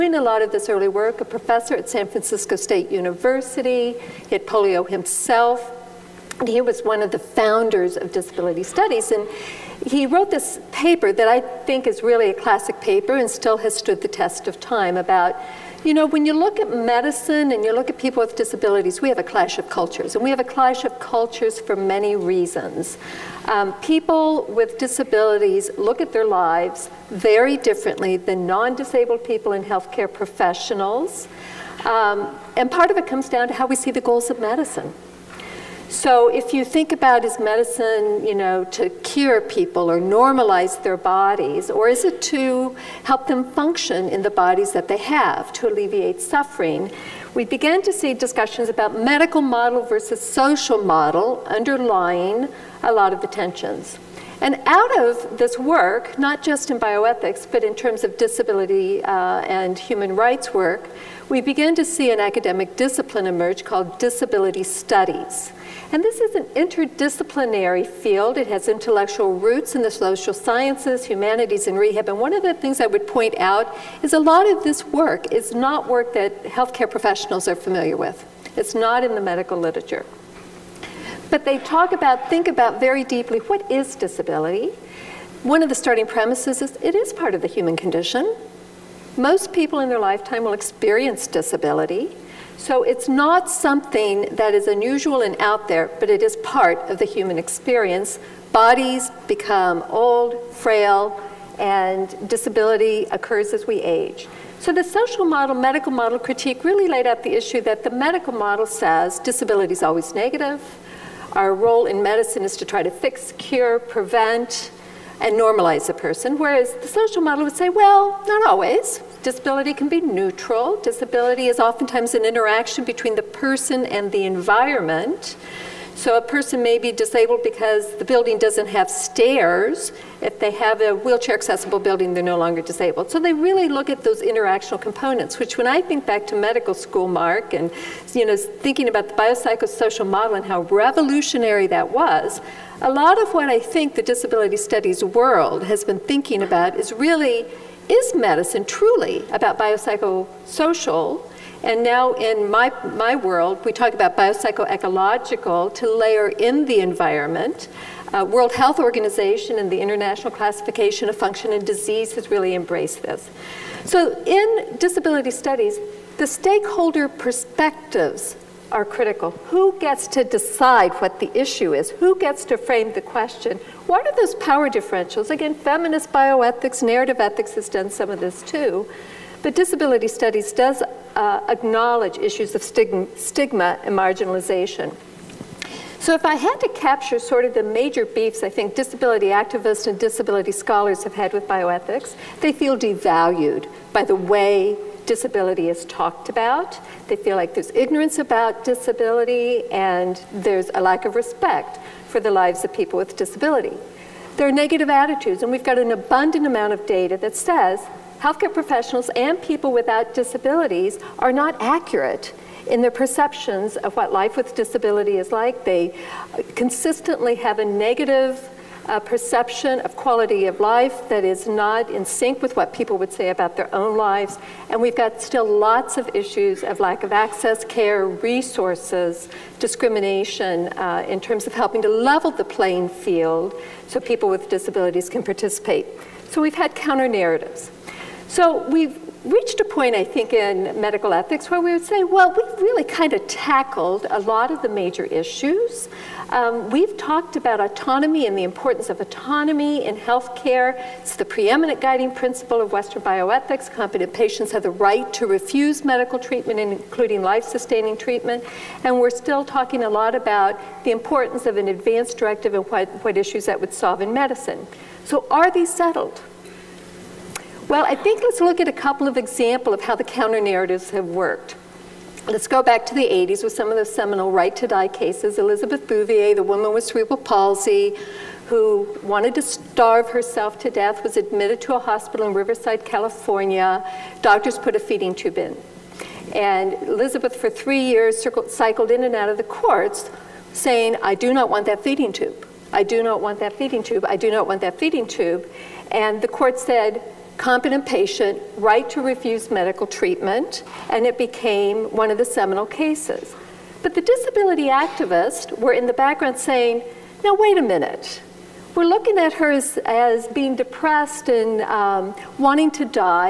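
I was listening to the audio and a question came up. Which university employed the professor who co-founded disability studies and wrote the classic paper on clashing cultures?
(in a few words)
San Francisco State University.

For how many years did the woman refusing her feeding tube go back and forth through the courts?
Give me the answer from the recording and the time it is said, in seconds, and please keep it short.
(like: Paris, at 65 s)
3, at 287 s.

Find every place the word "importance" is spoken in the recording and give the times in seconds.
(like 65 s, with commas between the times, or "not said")
248 s, 260 s.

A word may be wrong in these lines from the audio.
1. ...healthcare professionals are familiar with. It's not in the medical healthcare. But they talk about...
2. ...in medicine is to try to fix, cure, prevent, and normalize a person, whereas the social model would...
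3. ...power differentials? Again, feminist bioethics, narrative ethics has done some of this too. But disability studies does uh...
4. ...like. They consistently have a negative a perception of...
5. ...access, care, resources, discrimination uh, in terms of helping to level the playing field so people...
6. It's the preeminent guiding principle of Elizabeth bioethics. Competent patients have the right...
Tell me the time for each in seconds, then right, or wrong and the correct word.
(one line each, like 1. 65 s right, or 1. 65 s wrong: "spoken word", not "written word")
1. 76 s wrong: "literature", not "healthcare"
2. 111 s right
3. 174 s right
4. 215 s right
5. 227 s right
6. 250 s wrong: "Western", not "Elizabeth".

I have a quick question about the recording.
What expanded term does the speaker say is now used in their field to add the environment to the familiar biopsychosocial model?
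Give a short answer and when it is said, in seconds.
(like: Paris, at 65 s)
biopsychoecological, at 154 s.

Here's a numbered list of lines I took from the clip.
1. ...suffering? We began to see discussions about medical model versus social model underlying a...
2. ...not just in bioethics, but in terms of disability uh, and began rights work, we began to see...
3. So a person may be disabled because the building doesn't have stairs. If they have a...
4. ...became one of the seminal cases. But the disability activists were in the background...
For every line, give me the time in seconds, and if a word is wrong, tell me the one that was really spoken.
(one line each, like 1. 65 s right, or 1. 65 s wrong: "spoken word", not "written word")
1. 46 s right
2. 56 s wrong: "human", not "began"
3. 125 s right
4. 301 s right.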